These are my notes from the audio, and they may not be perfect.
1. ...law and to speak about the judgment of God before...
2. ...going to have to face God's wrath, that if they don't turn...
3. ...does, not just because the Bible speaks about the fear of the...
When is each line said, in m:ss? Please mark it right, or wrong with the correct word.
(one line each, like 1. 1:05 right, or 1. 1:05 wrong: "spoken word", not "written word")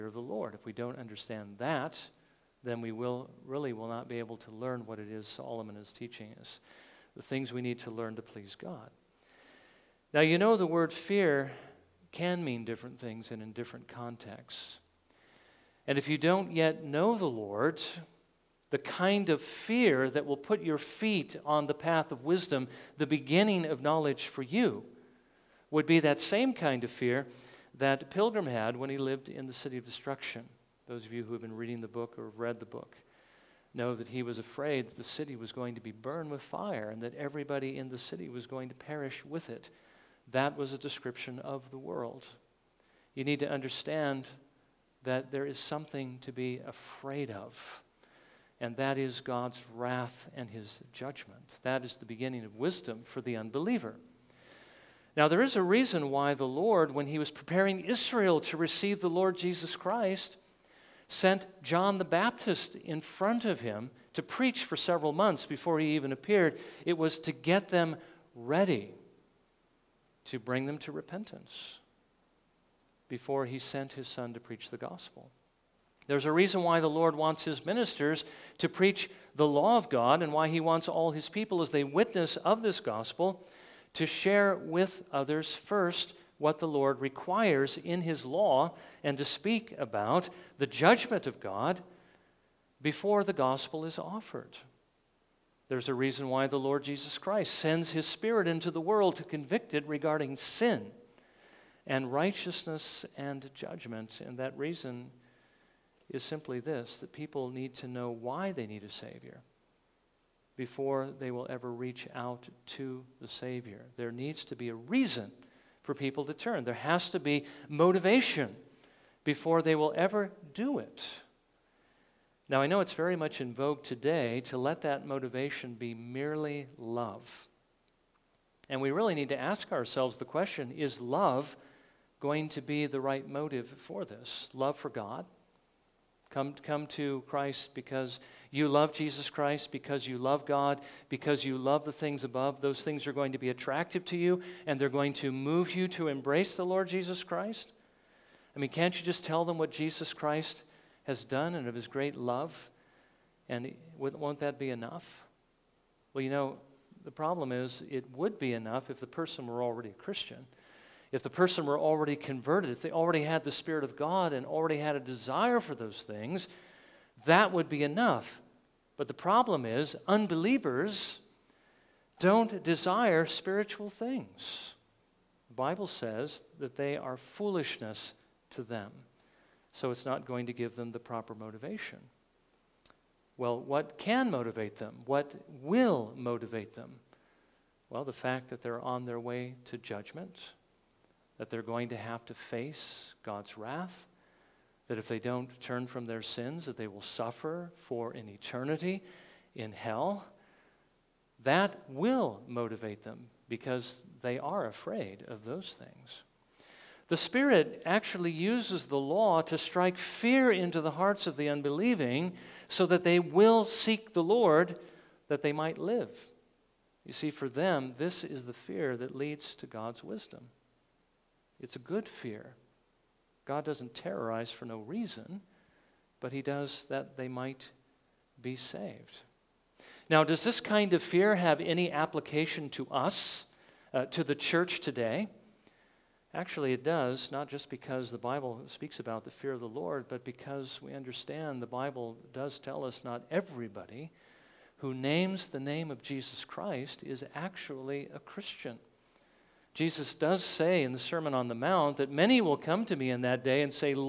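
1. 1:28 right
2. 3:11 right
3. 3:56 right.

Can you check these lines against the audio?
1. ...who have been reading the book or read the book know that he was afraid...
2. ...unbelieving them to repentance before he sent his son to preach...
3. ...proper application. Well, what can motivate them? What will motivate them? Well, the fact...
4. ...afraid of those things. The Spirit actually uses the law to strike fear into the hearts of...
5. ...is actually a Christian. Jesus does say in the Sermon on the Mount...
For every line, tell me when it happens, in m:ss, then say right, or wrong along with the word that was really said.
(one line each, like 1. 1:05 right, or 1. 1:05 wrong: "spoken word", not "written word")
1. 0:31 right
2. 1:10 wrong: "bring", not "unbelieving"
3. 3:00 wrong: "motivation", not "application"
4. 3:24 right
5. 4:07 right.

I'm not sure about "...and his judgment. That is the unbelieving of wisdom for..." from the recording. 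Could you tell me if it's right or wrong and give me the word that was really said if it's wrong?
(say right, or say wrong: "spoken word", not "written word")
wrong: "beginning", not "unbelieving".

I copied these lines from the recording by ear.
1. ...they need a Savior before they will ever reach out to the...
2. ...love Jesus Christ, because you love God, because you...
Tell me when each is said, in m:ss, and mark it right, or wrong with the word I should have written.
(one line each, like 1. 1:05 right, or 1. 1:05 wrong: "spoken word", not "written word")
1. 1:48 right
2. 2:18 right.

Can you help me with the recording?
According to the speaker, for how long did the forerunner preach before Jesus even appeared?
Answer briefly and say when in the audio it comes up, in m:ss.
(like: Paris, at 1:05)
several months, at 1:04.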